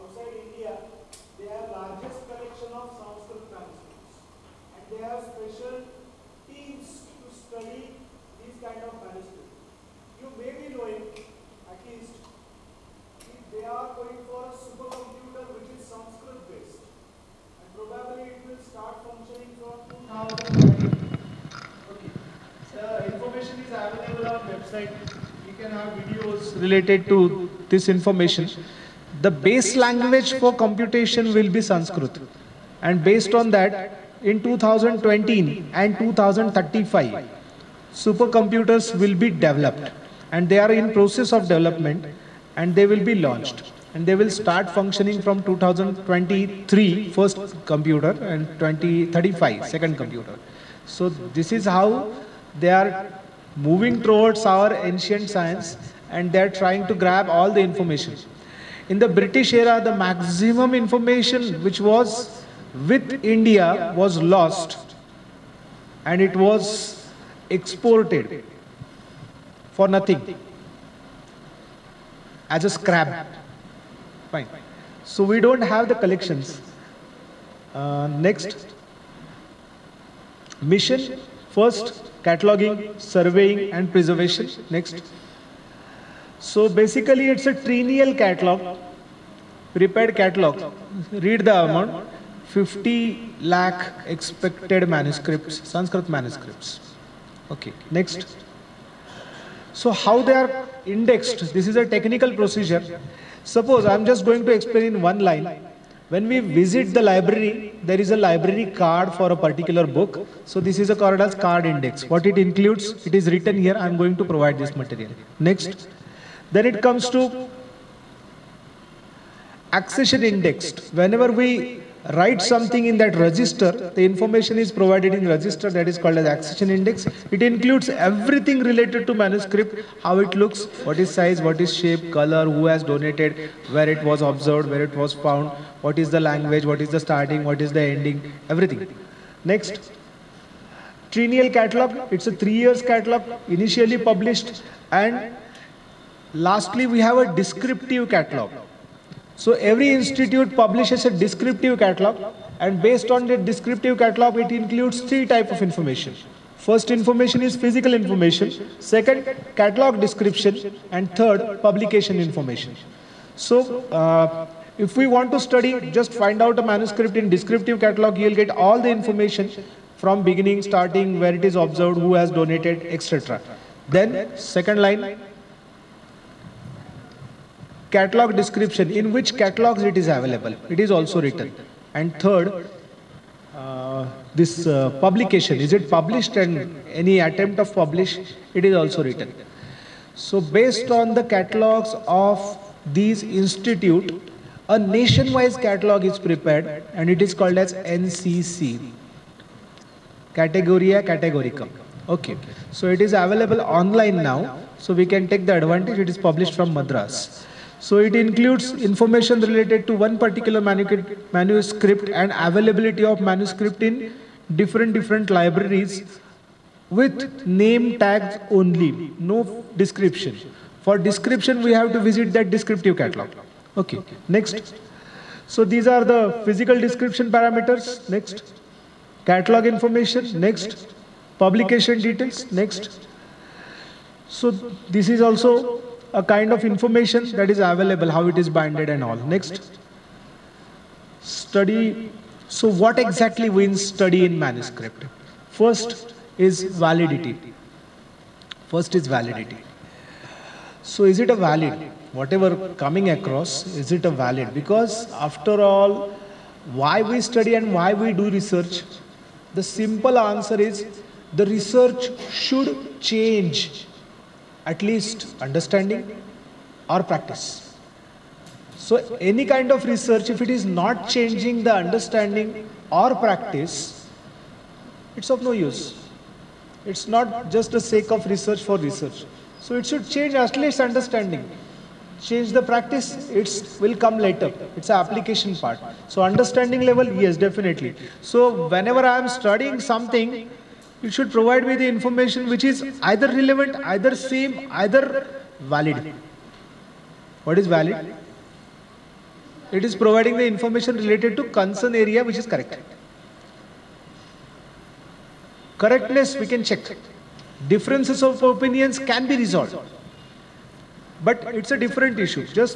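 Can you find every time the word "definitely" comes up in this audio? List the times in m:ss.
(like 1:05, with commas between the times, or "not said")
4:47.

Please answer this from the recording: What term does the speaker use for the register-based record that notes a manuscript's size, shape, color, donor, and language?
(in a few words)
Accession index.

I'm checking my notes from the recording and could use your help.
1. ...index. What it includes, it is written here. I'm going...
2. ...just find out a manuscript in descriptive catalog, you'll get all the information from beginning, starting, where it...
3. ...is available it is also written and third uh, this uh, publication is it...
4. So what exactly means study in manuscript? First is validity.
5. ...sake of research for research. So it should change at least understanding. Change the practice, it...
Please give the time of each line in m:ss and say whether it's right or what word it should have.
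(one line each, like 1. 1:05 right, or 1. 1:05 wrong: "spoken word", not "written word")
1. 1:51 right
2. 2:45 right
3. 3:00 right
4. 4:02 right
5. 4:37 right.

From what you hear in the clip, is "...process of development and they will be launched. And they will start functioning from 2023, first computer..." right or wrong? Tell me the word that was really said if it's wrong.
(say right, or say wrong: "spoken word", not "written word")
right.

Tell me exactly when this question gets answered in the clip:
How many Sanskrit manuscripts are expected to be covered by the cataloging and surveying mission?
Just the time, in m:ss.
1:32.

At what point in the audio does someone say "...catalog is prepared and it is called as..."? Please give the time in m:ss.
3:15.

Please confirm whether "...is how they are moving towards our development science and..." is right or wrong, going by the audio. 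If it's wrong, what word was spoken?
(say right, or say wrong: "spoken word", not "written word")
wrong: "ancient", not "development".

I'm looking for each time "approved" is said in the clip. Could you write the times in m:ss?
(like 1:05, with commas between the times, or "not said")
not said.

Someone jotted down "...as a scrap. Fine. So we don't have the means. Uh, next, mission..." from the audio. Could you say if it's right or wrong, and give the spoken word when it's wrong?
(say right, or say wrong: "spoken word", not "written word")
wrong: "collections", not "means".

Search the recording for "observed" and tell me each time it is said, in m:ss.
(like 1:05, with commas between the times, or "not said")
2:14, 2:51.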